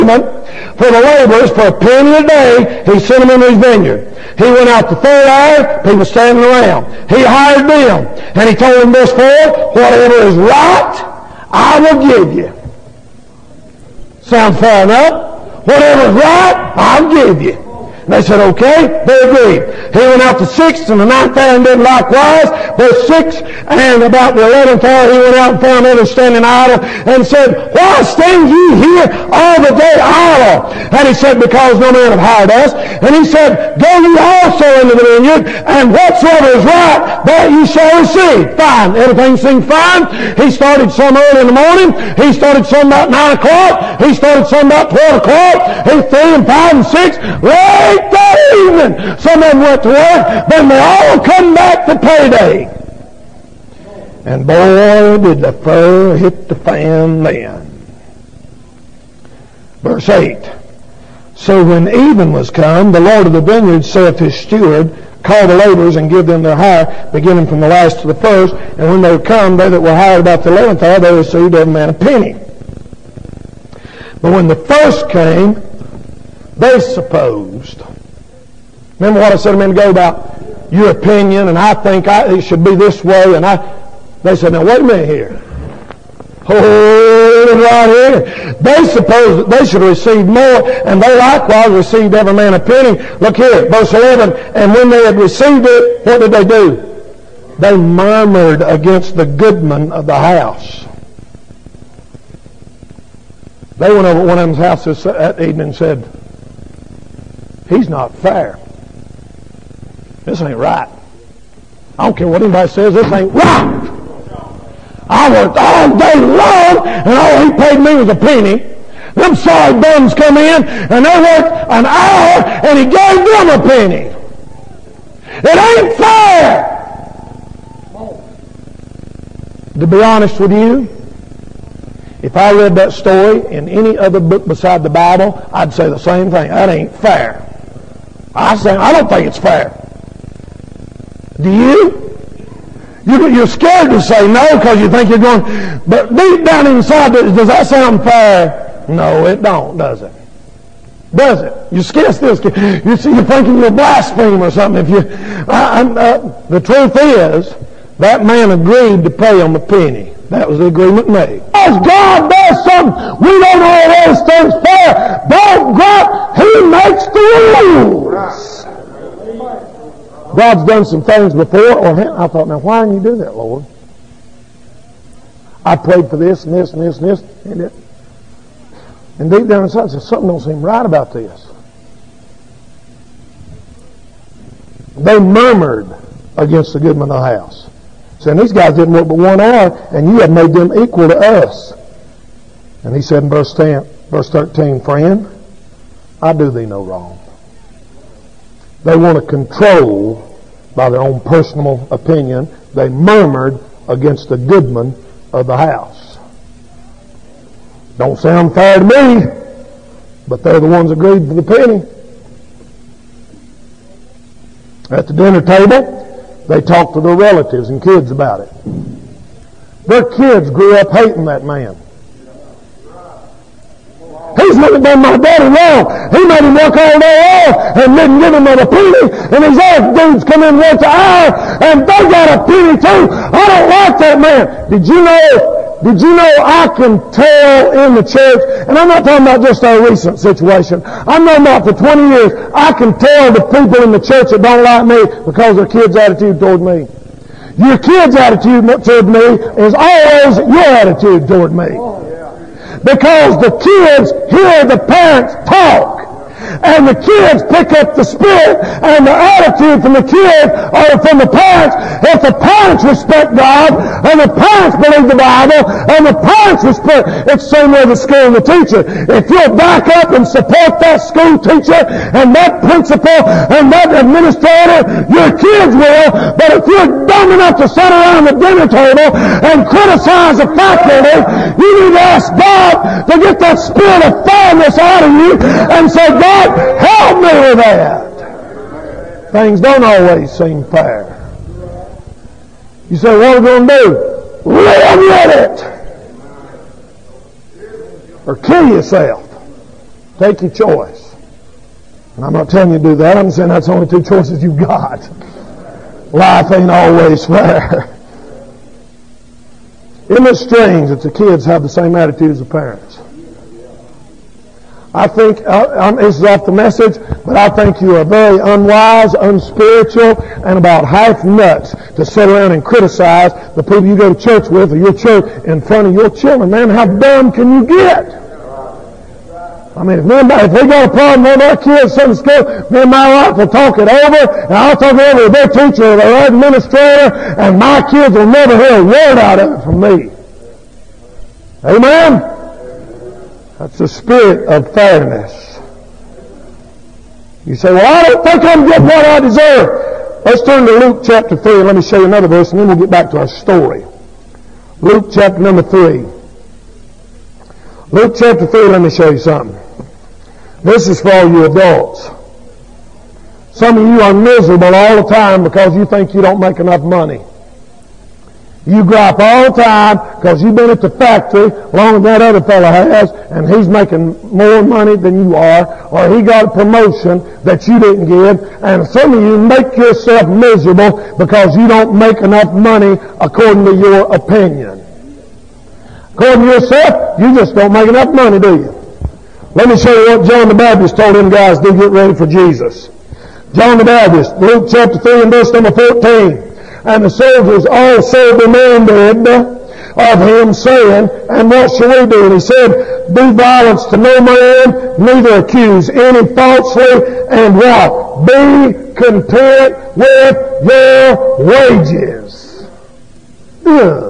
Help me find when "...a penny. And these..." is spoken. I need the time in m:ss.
3:48.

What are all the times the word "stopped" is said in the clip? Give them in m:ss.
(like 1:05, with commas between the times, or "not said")
not said.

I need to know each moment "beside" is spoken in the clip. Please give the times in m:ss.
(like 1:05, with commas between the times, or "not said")
2:14.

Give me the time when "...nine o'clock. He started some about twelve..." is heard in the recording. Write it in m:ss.
0:43.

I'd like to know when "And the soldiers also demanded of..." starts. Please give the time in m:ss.
6:36.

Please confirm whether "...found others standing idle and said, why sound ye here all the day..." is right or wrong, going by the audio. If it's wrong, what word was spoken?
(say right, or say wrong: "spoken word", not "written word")
wrong: "stand", not "sound".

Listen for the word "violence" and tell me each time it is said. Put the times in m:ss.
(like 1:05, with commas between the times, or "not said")
6:43.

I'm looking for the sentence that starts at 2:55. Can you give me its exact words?
I prayed for this and this and this and this, and it.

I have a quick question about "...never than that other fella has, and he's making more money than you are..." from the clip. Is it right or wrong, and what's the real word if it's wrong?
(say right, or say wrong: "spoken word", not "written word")
wrong: "longer", not "never".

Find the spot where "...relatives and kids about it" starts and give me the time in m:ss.
3:37.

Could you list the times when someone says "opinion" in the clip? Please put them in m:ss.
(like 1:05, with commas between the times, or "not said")
1:20, 3:21, 6:24.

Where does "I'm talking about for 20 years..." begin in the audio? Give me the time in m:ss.
4:00.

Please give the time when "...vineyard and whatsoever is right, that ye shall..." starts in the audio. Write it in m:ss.
0:35.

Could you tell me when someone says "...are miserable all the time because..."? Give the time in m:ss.
6:04.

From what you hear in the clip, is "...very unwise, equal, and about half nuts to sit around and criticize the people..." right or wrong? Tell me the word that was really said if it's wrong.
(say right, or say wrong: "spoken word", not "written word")
wrong: "unspiritual", not "equal".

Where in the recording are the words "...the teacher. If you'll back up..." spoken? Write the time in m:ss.
4:28.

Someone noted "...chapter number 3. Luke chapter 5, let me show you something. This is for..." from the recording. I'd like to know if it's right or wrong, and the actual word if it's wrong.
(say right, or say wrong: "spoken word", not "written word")
wrong: "3", not "5".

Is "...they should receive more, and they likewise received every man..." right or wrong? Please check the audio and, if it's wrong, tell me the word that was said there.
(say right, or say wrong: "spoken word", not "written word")
right.